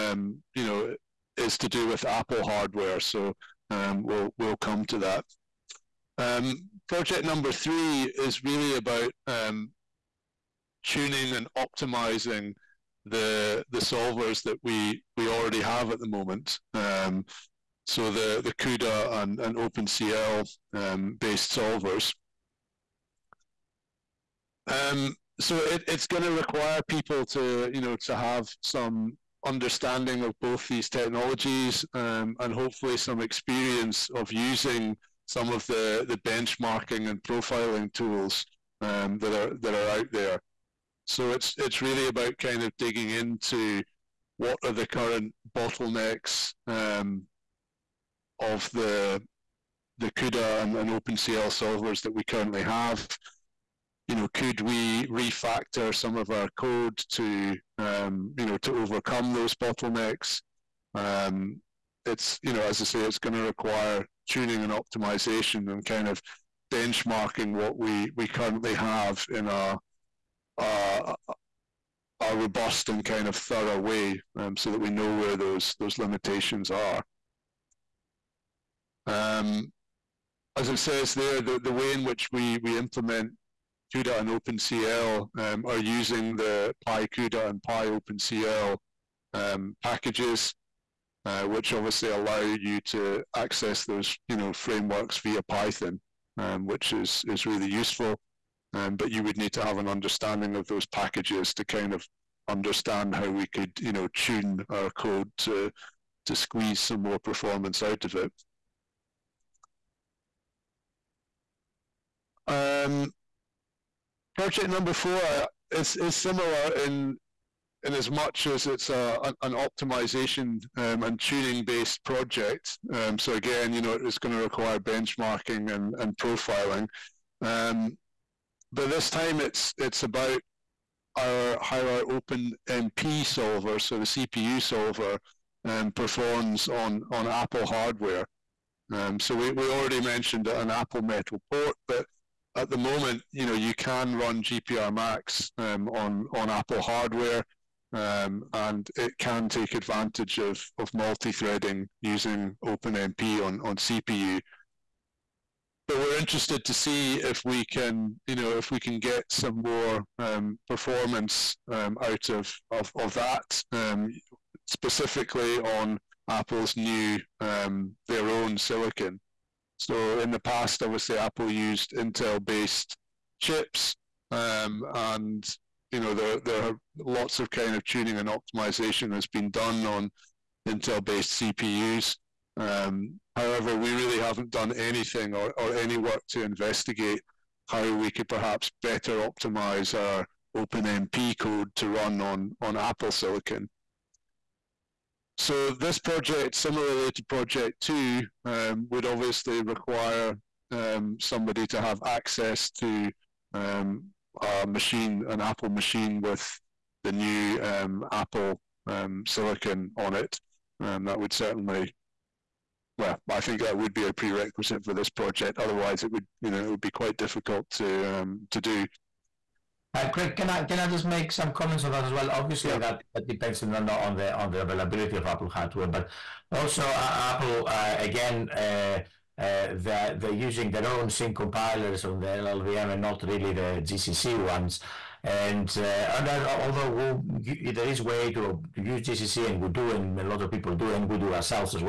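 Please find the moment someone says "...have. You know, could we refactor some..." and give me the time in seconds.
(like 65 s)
52 s.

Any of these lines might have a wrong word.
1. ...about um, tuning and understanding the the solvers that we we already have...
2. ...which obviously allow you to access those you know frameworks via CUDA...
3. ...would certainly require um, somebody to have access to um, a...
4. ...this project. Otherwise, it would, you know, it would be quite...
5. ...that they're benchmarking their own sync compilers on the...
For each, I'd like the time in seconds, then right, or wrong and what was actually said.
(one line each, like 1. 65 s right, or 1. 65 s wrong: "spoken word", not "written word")
1. 8 s wrong: "optimizing", not "understanding"
2. 91 s wrong: "Python", not "CUDA"
3. 198 s wrong: "obviously", not "certainly"
4. 214 s right
5. 229 s wrong: "using", not "benchmarking".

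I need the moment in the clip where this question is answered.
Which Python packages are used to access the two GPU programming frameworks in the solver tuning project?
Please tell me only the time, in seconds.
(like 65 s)
86 s.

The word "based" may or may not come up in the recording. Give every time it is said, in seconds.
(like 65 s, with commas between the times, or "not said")
21 s, 121 s, 171 s, 180 s.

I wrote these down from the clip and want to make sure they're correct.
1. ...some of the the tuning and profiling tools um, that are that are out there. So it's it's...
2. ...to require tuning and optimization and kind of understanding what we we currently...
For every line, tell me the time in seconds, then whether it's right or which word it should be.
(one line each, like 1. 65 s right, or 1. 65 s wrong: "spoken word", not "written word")
1. 35 s wrong: "benchmarking", not "tuning"
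2. 63 s wrong: "benchmarking", not "understanding".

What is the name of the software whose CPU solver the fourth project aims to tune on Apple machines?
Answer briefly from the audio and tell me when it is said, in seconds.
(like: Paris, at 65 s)
gprMax, at 144 s.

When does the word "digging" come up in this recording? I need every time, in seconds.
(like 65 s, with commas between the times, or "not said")
42 s.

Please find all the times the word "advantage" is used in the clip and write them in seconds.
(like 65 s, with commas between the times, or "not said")
149 s.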